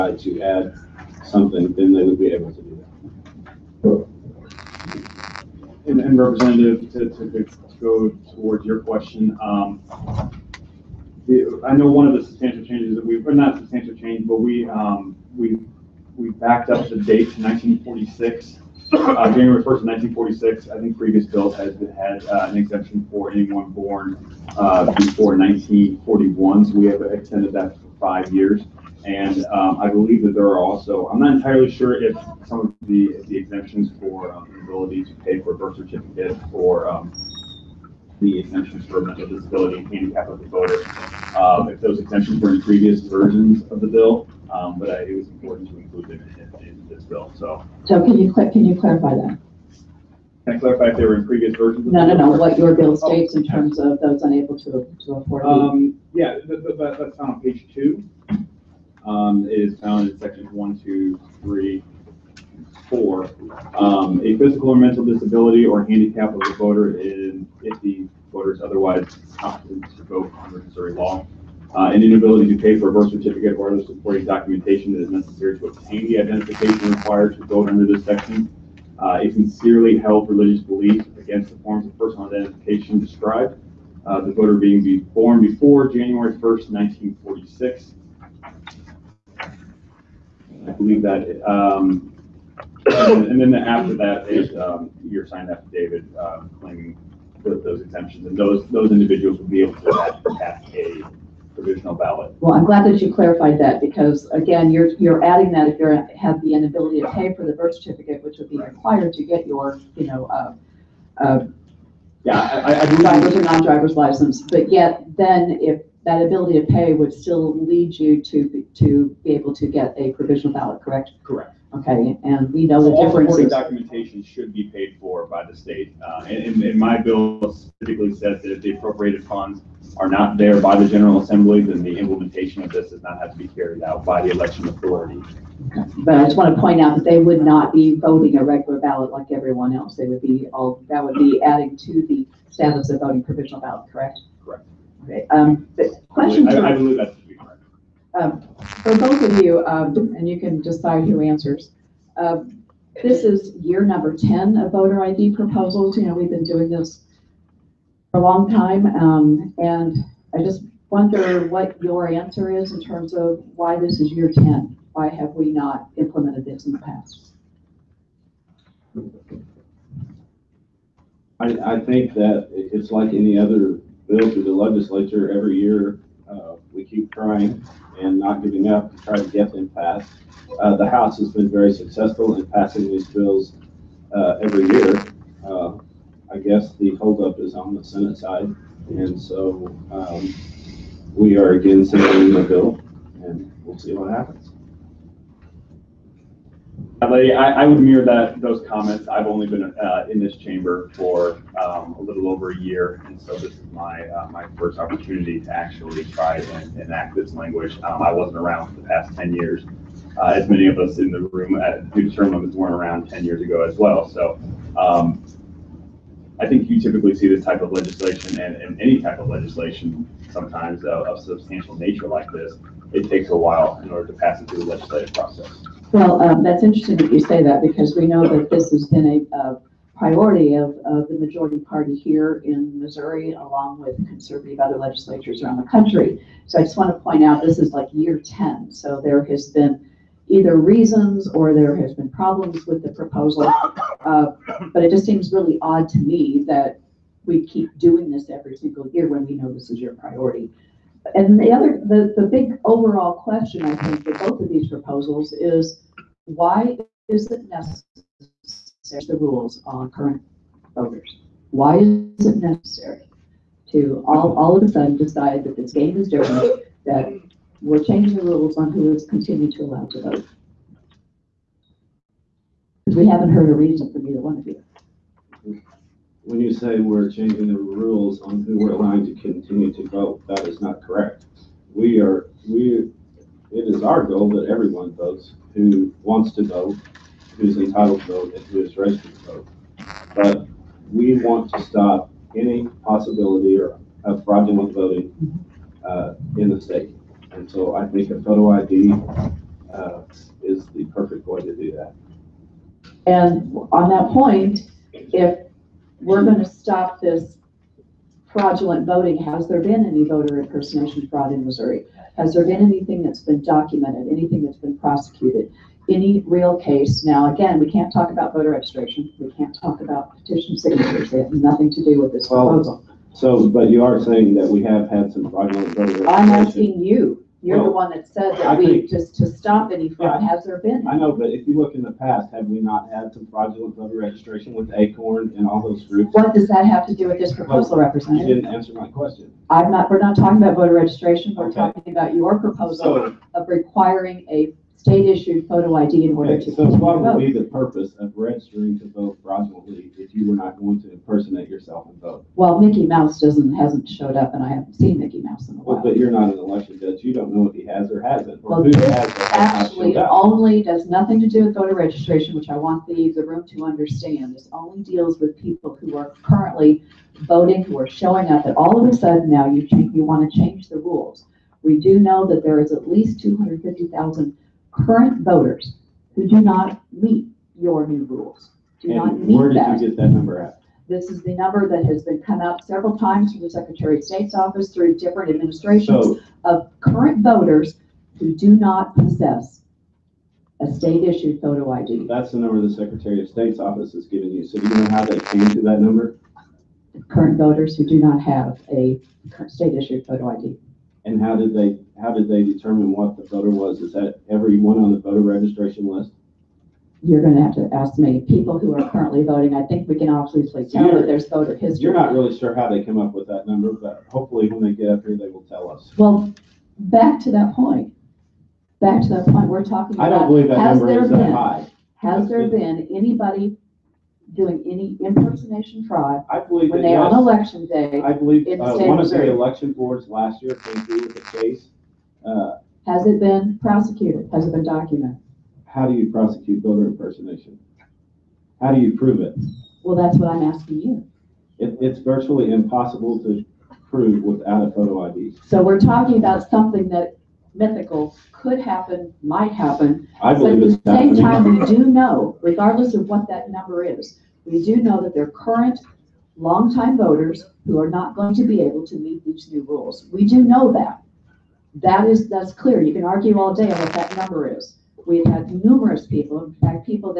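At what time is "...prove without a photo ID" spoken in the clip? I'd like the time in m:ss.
7:23.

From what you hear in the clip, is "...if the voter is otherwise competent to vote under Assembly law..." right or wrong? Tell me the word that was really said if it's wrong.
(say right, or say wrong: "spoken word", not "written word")
wrong: "Missouri", not "Assembly".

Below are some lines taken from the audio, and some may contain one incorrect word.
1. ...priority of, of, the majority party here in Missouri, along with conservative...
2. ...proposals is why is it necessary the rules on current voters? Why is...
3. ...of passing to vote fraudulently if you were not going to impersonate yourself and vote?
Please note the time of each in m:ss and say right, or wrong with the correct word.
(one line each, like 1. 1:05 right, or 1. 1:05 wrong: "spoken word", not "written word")
1. 3:49 right
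2. 4:14 right
3. 5:47 wrong: "registering", not "passing".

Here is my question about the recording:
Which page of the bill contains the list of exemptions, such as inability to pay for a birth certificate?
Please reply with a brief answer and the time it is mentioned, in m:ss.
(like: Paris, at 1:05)
Page two, at 0:57.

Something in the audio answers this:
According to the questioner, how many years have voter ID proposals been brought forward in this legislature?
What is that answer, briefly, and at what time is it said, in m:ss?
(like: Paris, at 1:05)
10, at 2:33.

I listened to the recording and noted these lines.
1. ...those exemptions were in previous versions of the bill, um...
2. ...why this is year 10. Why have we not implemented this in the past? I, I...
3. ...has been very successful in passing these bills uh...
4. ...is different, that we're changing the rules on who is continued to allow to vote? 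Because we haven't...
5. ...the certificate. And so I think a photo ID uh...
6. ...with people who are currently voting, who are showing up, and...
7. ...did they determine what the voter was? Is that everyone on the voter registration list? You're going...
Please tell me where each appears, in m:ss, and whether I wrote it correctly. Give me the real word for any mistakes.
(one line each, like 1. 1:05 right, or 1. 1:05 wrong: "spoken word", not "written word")
1. 0:41 right
2. 2:43 right
3. 3:01 right
4. 4:25 right
5. 4:56 wrong: "state", not "certificate"
6. 6:05 right
7. 6:42 right.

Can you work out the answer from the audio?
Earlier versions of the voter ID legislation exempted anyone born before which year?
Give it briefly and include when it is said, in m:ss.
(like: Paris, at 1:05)
1941, at 0:25.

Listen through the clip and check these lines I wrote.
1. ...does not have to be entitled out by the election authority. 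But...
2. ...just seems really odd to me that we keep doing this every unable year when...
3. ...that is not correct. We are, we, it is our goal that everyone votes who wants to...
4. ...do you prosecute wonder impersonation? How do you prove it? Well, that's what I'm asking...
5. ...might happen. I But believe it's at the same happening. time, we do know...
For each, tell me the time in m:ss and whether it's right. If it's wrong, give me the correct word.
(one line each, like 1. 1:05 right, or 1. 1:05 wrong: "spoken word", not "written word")
1. 2:12 wrong: "carried", not "entitled"
2. 4:04 wrong: "single", not "unable"
3. 4:40 right
4. 7:15 wrong: "voter", not "wonder"
5. 7:29 right.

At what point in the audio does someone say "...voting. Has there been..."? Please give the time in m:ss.
5:08.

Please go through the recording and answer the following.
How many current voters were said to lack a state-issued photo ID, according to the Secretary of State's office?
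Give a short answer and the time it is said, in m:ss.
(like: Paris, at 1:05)
250,000, at 6:13.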